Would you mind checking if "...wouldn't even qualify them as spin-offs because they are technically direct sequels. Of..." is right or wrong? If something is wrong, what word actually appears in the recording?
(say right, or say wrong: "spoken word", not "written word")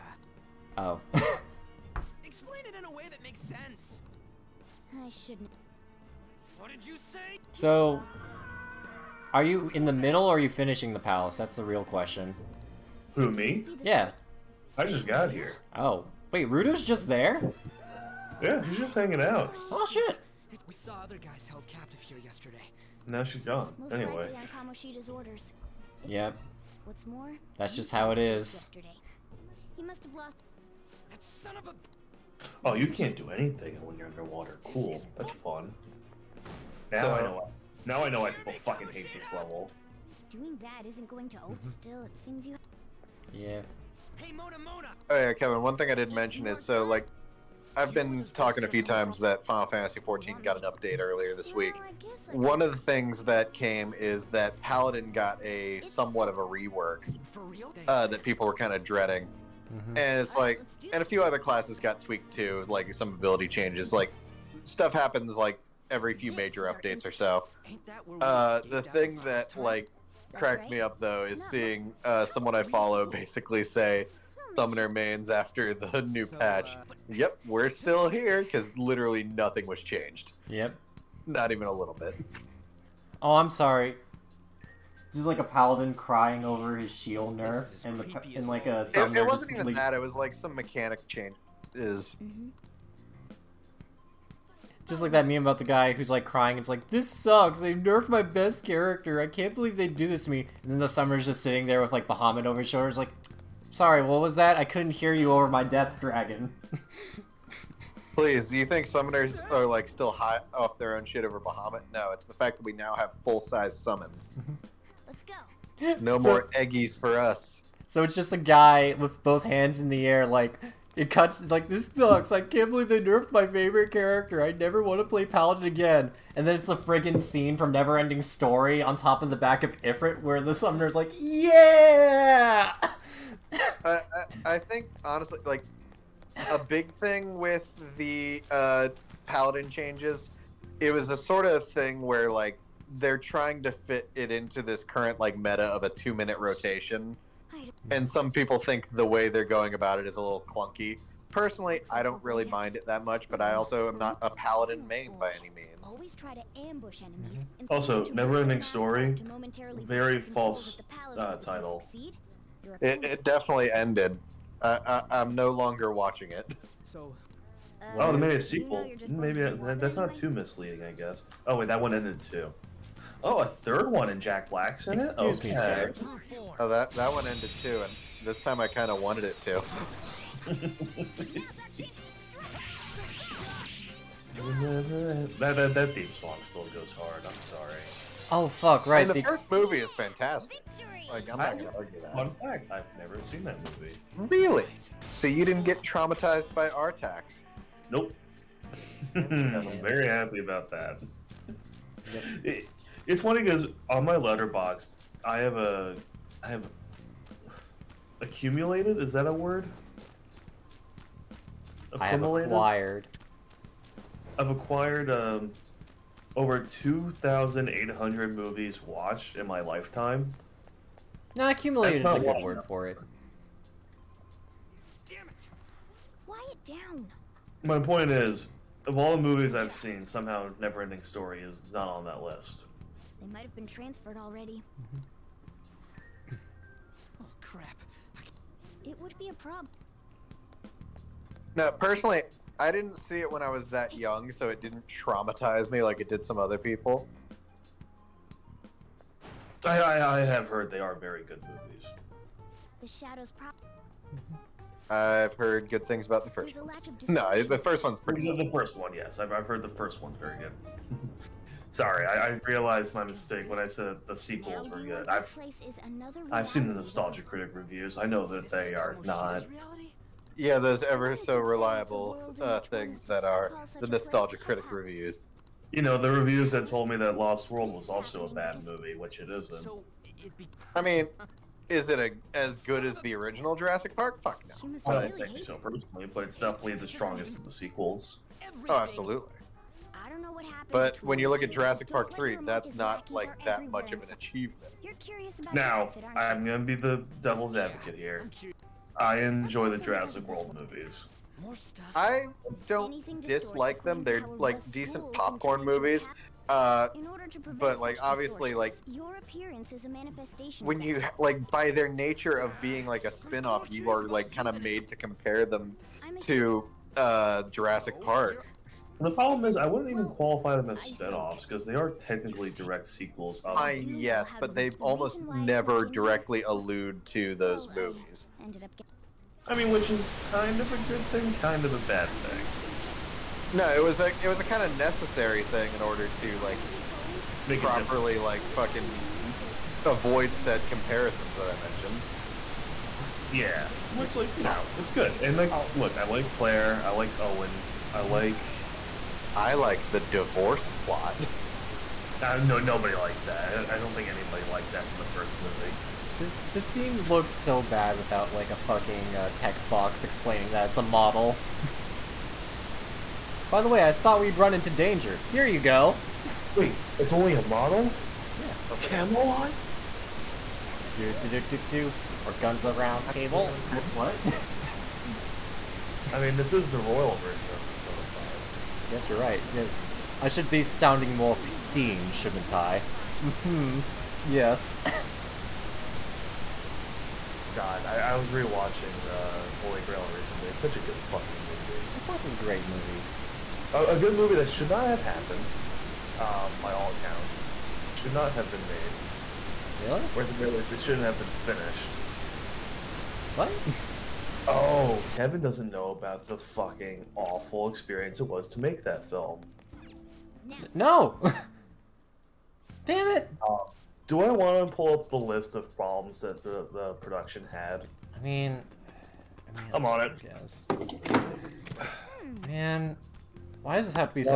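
right.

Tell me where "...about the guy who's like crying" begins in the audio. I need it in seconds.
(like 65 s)
95 s.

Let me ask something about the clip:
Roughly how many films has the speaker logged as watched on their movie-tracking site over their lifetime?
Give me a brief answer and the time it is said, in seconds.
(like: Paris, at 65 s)
over 2,800, at 216 s.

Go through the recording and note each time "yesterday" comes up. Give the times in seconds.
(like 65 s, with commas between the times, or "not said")
22 s, 28 s.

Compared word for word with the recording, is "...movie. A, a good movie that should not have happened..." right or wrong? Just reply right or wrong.
right.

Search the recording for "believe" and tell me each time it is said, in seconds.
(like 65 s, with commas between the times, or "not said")
99 s, 122 s.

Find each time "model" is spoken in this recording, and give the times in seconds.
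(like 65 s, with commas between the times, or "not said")
360 s, 367 s.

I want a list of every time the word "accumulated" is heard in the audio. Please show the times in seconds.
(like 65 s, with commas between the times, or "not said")
208 s, 221 s.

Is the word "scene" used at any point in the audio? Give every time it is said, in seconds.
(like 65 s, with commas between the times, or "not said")
127 s, 356 s.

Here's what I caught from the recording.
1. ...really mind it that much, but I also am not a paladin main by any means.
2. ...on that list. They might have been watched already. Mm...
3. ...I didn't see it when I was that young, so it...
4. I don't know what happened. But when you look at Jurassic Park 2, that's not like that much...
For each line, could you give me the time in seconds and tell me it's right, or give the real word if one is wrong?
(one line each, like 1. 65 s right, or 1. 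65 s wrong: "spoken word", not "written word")
1. 152 s right
2. 231 s wrong: "transferred", not "watched"
3. 242 s right
4. 290 s wrong: "3", not "2".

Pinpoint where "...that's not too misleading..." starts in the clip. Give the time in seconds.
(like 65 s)
169 s.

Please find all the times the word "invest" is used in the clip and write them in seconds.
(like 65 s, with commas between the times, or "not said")
not said.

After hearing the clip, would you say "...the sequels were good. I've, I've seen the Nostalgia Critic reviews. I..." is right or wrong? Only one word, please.
right.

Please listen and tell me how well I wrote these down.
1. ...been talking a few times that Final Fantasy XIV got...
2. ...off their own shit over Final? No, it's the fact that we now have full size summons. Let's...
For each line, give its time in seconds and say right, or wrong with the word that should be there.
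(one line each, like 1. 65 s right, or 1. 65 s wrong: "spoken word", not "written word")
1. 47 s right
2. 110 s wrong: "Bahamut", not "Final".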